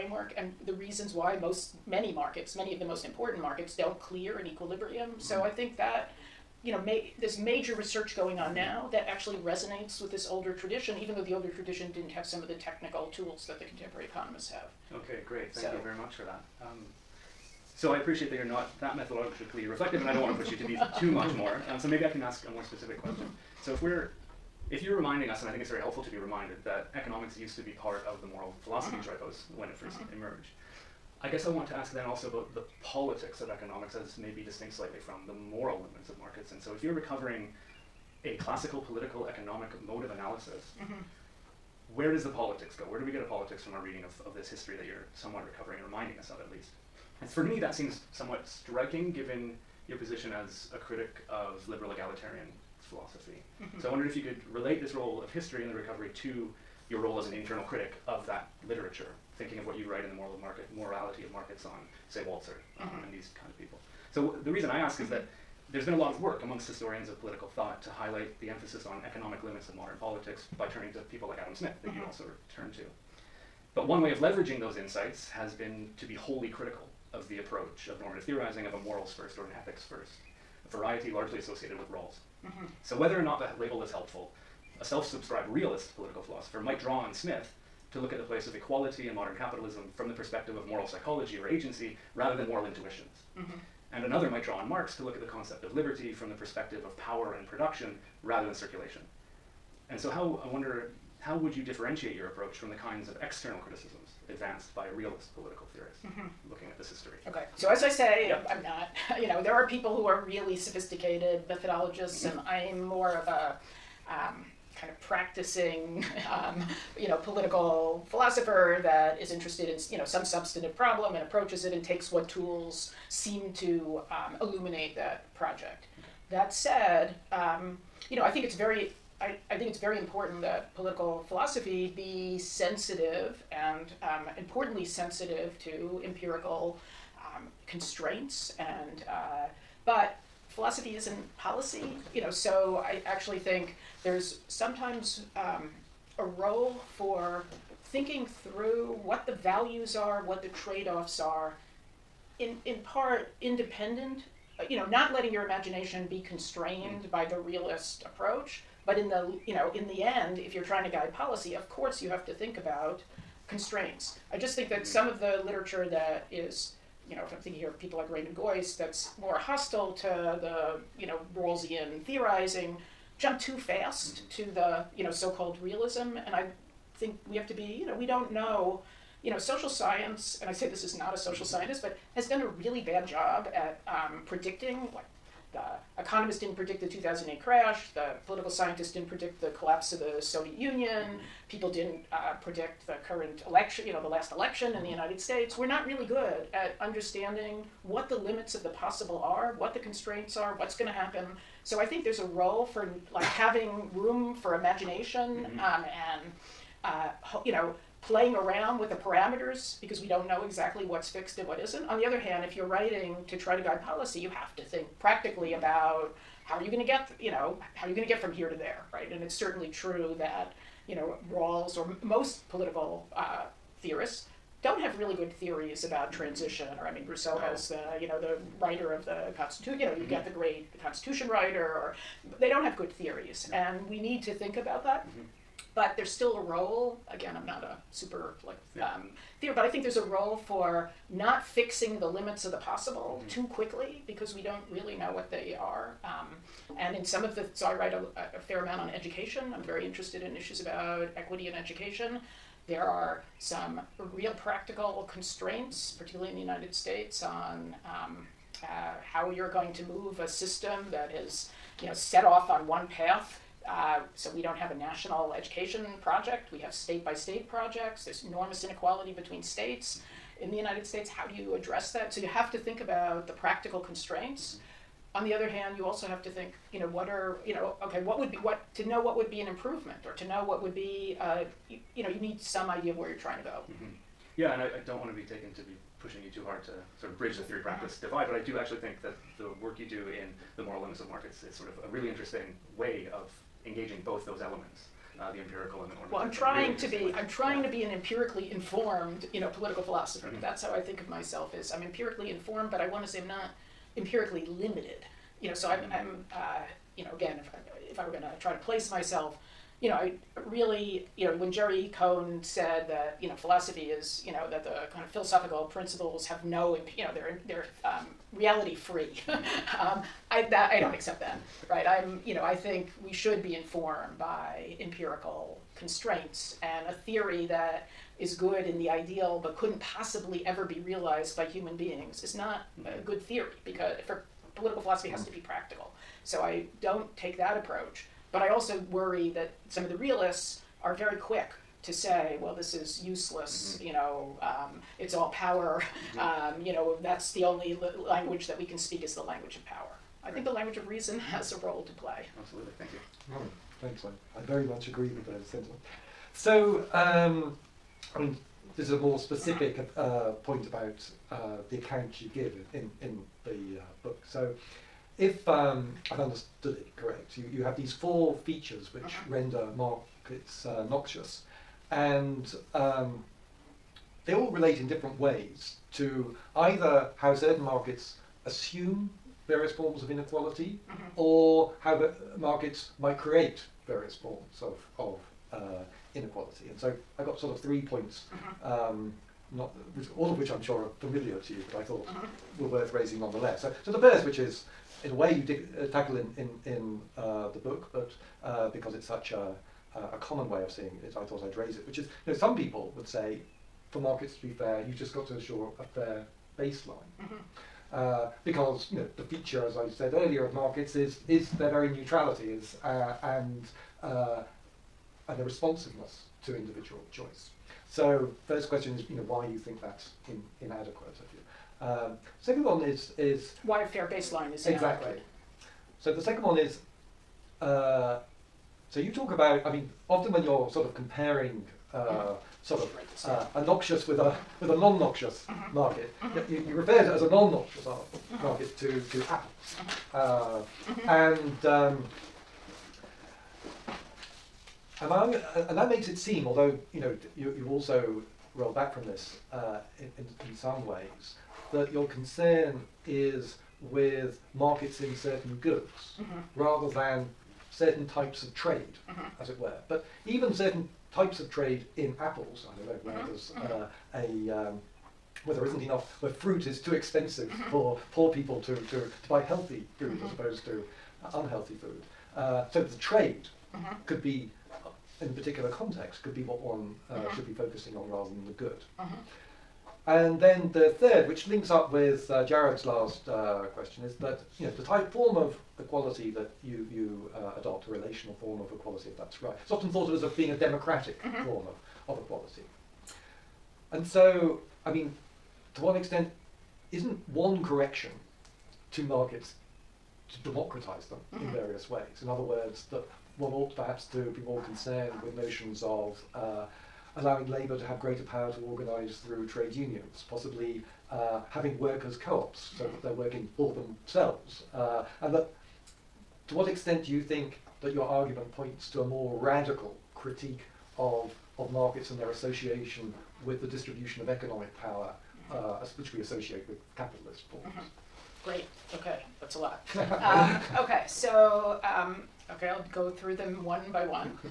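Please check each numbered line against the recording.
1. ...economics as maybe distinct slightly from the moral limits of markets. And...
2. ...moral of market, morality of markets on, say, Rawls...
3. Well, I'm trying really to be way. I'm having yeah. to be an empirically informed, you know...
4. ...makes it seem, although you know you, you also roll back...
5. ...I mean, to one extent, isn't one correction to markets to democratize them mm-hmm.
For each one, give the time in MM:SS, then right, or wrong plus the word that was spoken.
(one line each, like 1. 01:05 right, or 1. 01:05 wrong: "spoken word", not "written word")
1. 00:33 right
2. 01:00 wrong: "Walzer", not "Rawls"
3. 04:56 wrong: "trying", not "having"
4. 07:25 right
5. 08:14 right.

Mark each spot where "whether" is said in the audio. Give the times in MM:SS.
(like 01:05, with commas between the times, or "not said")
01:22.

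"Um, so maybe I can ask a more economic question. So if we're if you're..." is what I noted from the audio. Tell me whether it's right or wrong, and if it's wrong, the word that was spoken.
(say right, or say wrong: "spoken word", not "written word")
wrong: "specific", not "economic".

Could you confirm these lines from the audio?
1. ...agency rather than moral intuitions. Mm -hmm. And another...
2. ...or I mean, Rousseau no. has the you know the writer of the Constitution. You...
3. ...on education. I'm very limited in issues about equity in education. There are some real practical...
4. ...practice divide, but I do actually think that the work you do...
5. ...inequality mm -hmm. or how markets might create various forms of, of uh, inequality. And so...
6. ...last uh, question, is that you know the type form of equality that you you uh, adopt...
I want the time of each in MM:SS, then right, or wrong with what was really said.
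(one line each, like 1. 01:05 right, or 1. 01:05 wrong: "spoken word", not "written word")
1. 01:31 right
2. 03:46 right
3. 04:08 wrong: "interested", not "limited"
4. 04:47 right
5. 06:20 right
6. 08:02 right.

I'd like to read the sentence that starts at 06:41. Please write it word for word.
Which is, you know, some people would say, for markets to be fair, you've just got to assure a fair baseline.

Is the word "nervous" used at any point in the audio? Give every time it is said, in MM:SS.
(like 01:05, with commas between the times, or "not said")
not said.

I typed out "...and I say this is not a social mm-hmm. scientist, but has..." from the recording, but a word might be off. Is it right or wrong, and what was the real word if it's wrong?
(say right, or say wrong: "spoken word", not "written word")
right.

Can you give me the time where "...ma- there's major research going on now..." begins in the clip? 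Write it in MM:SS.
00:06.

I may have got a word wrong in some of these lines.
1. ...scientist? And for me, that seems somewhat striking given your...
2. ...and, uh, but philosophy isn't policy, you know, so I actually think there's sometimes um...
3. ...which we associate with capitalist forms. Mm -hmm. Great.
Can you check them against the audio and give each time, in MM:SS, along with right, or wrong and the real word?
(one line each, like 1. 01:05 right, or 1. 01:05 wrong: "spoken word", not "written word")
1. 00:46 wrong: "least", not "scientist"
2. 02:18 right
3. 08:45 right.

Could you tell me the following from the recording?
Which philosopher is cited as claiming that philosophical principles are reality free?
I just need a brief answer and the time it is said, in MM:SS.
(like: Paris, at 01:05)
Jerry Cohen, at 05:11.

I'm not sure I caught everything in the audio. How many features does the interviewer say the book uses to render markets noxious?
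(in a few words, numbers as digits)
4.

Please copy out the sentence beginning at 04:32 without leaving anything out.
So you have to think about the practical constraints.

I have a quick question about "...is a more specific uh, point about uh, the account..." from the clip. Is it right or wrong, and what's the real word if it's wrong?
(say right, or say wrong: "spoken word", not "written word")
right.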